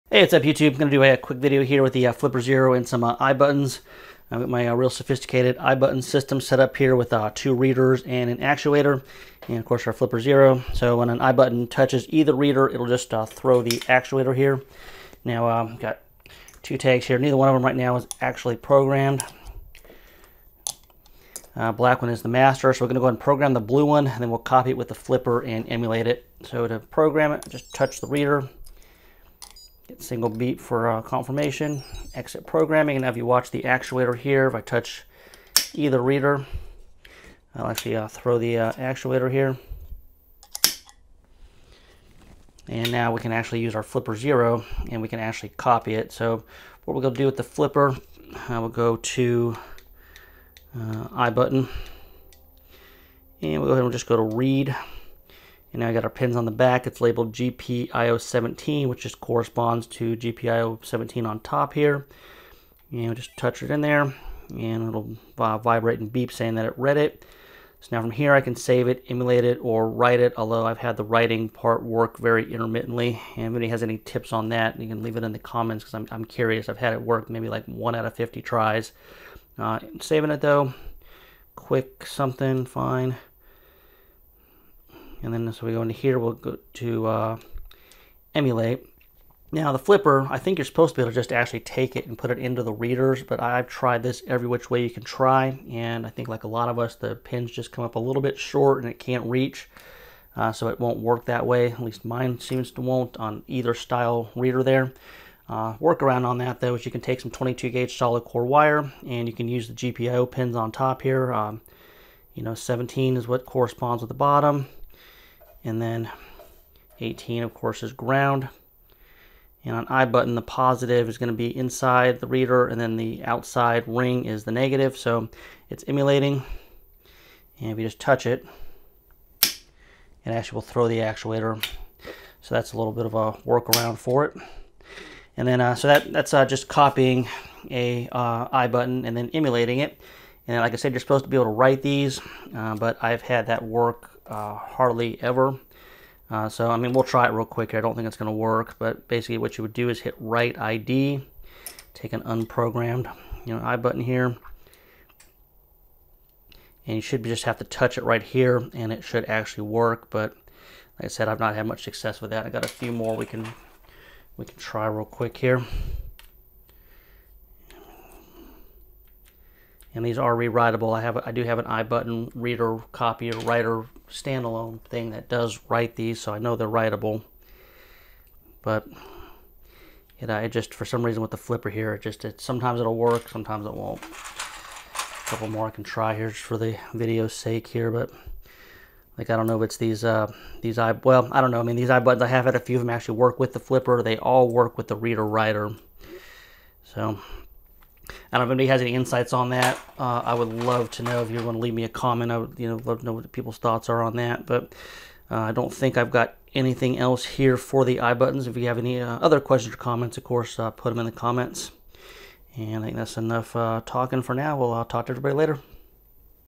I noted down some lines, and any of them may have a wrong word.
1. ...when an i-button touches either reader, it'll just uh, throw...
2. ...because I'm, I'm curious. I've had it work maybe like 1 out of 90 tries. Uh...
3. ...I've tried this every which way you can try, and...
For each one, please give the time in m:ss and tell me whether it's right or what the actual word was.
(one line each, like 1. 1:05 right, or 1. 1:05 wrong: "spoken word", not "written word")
1. 0:10 right
2. 1:15 wrong: "50", not "90"
3. 1:33 right.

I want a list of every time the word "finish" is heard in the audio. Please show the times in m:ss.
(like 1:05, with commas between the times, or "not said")
not said.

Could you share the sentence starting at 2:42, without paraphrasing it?
I got a few more we can, we can try real quick here.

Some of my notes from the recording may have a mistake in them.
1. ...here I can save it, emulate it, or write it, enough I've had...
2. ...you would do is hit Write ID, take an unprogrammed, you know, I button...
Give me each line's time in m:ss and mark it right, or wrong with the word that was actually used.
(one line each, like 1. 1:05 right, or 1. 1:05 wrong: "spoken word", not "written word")
1. 1:08 wrong: "although", not "enough"
2. 2:29 right.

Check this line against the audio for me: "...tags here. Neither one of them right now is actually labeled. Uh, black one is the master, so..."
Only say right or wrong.
wrong.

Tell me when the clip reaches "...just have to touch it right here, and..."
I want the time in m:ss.
2:37.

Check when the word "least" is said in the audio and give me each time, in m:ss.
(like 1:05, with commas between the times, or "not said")
1:41.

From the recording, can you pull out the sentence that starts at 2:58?
But you it, I just, for some reason with the flipper here, it just, it, sometimes it'll work, sometimes it won't.